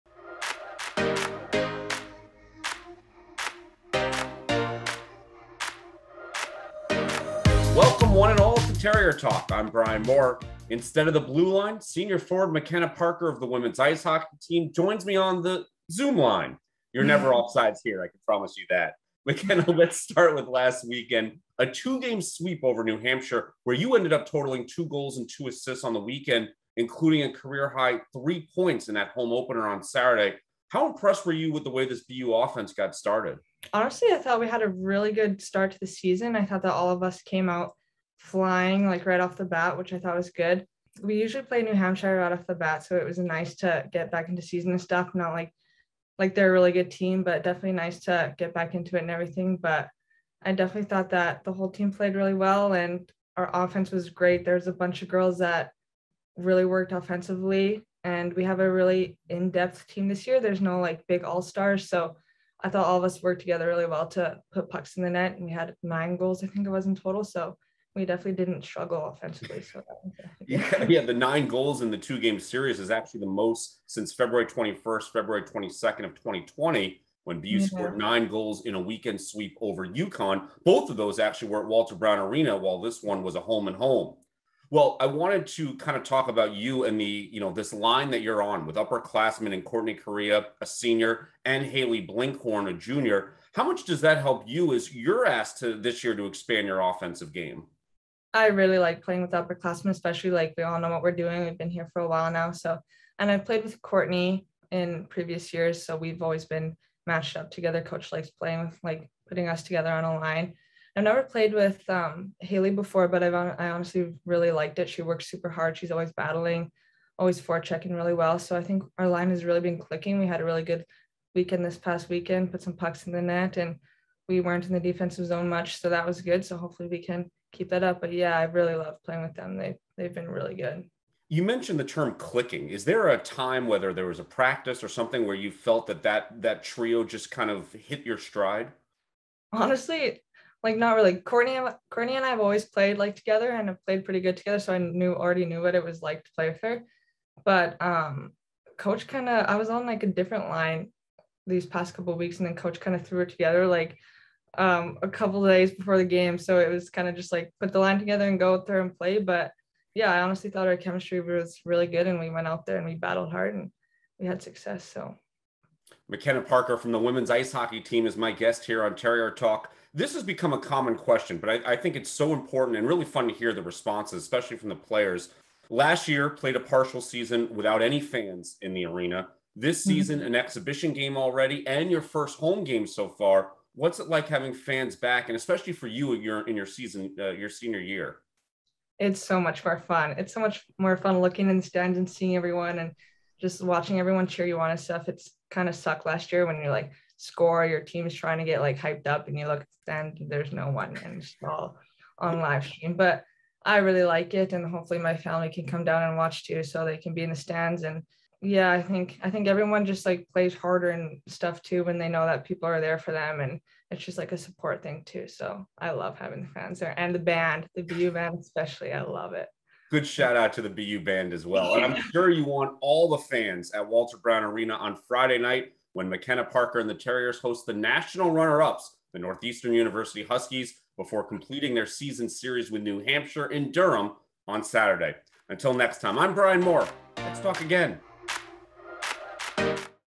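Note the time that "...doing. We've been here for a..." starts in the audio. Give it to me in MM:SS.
01:41.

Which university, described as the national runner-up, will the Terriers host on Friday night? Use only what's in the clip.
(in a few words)
Northeastern University.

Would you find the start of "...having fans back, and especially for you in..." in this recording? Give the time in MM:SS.
03:04.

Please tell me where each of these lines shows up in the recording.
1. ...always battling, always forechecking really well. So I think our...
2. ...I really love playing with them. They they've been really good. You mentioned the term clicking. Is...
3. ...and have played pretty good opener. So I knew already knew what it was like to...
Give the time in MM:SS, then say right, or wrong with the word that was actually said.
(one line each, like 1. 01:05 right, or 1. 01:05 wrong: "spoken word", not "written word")
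1. 01:55 right
2. 02:08 right
3. 02:23 wrong: "together", not "opener".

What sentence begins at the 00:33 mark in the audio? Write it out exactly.
Honestly, I thought we had a really good start to the season.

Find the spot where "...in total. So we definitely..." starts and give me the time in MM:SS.
01:06.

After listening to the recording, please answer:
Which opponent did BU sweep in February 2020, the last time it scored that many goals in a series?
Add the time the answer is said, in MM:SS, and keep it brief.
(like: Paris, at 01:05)
UConn, at 01:19.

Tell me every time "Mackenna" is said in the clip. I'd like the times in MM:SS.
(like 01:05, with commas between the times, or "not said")
00:12, 00:19, 02:46, 03:46.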